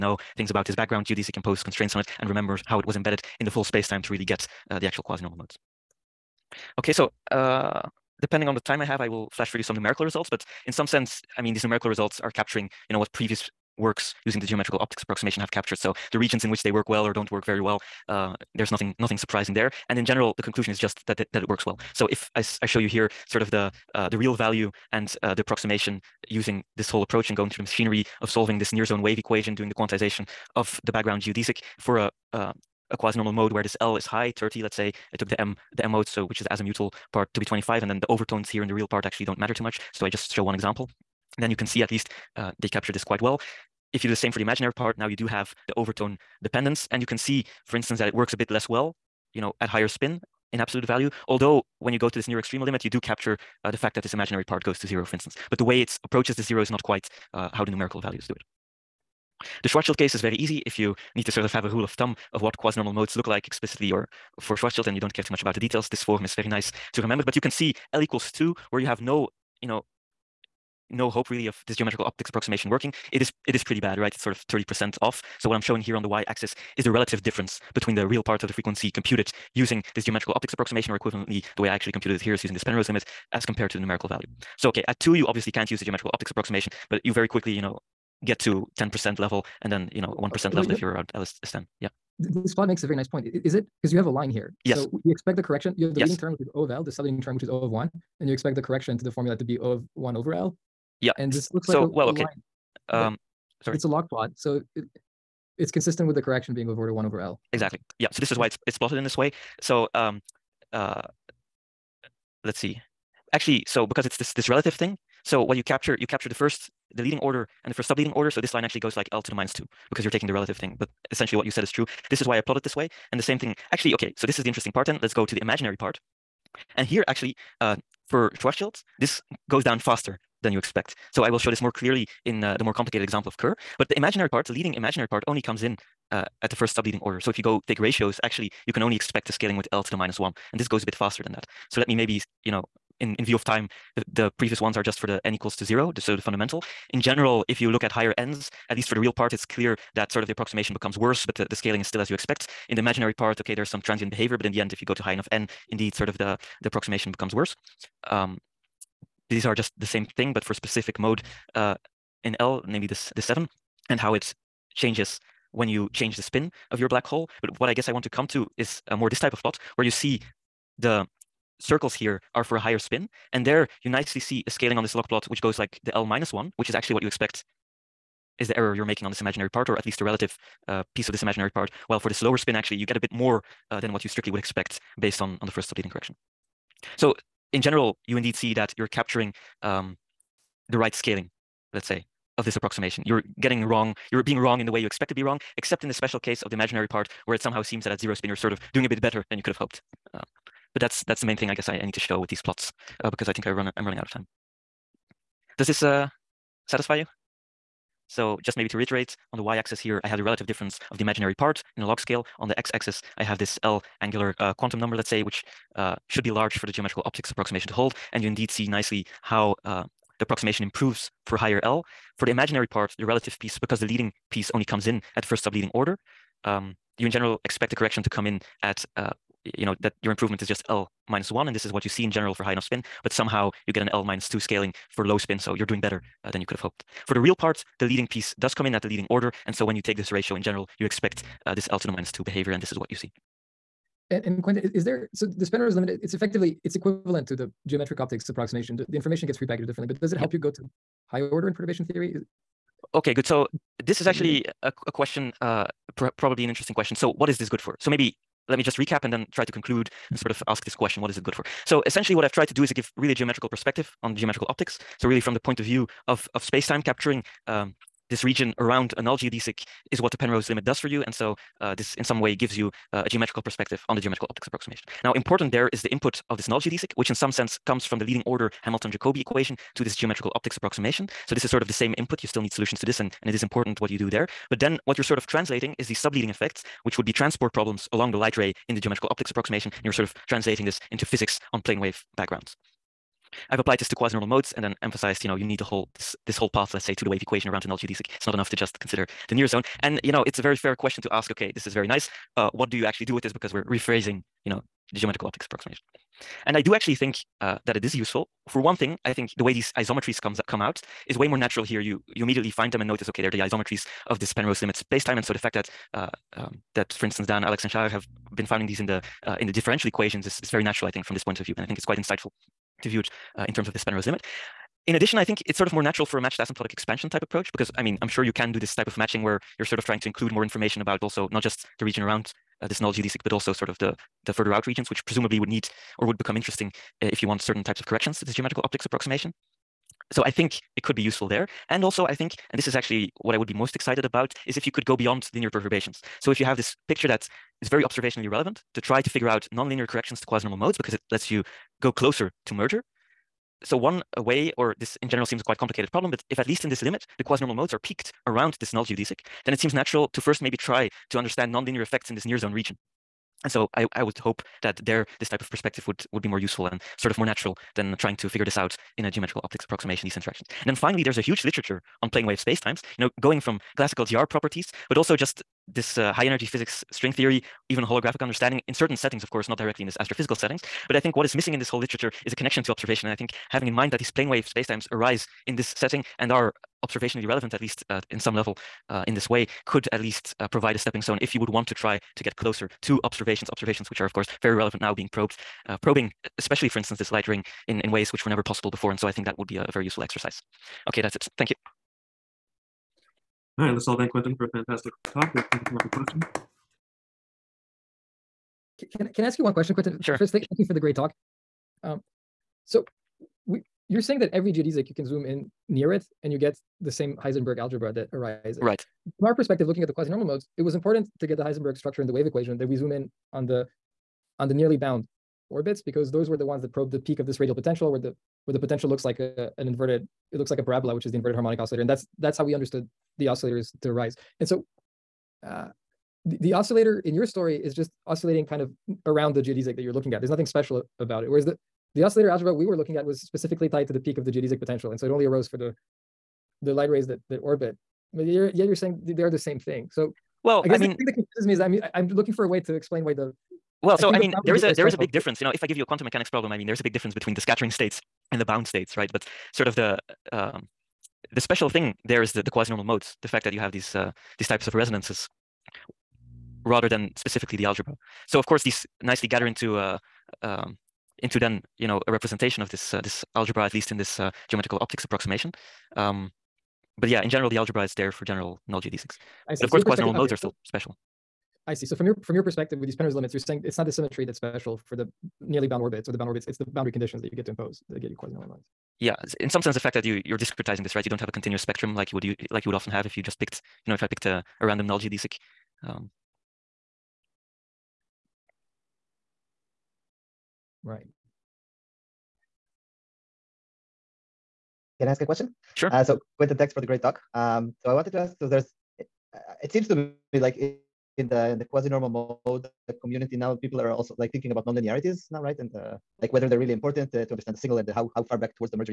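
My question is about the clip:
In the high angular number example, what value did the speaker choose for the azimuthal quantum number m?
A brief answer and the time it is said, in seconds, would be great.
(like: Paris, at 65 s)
25, at 37 s.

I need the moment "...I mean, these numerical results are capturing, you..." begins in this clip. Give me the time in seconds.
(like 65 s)
11 s.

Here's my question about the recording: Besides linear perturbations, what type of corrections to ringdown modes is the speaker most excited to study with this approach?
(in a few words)
nonlinear corrections.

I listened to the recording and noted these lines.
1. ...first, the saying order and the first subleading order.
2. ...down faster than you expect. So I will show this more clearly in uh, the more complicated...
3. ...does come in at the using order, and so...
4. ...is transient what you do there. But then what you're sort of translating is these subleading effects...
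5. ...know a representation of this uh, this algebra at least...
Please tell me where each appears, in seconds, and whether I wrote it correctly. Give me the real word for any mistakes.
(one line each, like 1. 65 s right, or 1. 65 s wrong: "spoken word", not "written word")
1. 116 s wrong: "leading", not "saying"
2. 129 s right
3. 238 s wrong: "leading", not "using"
4. 283 s wrong: "important", not "transient"
5. 471 s right.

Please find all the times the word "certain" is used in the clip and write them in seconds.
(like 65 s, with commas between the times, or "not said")
337 s, 378 s.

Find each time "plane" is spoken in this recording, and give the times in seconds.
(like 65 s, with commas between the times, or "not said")
291 s, 372 s, 384 s.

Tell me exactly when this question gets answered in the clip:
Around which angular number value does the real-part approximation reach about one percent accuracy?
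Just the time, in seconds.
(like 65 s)
91 s.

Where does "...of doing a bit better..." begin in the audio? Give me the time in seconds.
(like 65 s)
198 s.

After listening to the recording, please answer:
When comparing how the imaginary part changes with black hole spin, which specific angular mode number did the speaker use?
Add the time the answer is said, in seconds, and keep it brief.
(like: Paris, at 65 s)
7, at 163 s.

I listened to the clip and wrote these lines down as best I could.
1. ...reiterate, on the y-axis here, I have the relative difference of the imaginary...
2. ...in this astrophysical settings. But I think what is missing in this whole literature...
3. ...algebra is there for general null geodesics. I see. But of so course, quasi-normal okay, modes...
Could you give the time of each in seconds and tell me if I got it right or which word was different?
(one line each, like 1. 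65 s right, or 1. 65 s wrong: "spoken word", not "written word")
1. 208 s right
2. 379 s right
3. 477 s right.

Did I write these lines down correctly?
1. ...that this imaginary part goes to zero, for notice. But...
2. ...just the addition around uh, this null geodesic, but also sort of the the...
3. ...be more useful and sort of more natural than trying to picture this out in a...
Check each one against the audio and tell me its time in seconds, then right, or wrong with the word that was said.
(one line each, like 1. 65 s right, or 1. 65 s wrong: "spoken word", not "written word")
1. 53 s wrong: "instance", not "notice"
2. 331 s wrong: "region", not "addition"
3. 366 s wrong: "figure", not "picture".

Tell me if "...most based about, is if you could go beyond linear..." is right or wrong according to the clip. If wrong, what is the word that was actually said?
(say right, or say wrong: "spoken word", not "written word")
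wrong: "excited", not "based".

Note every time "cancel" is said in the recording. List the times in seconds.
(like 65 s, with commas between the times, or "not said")
not said.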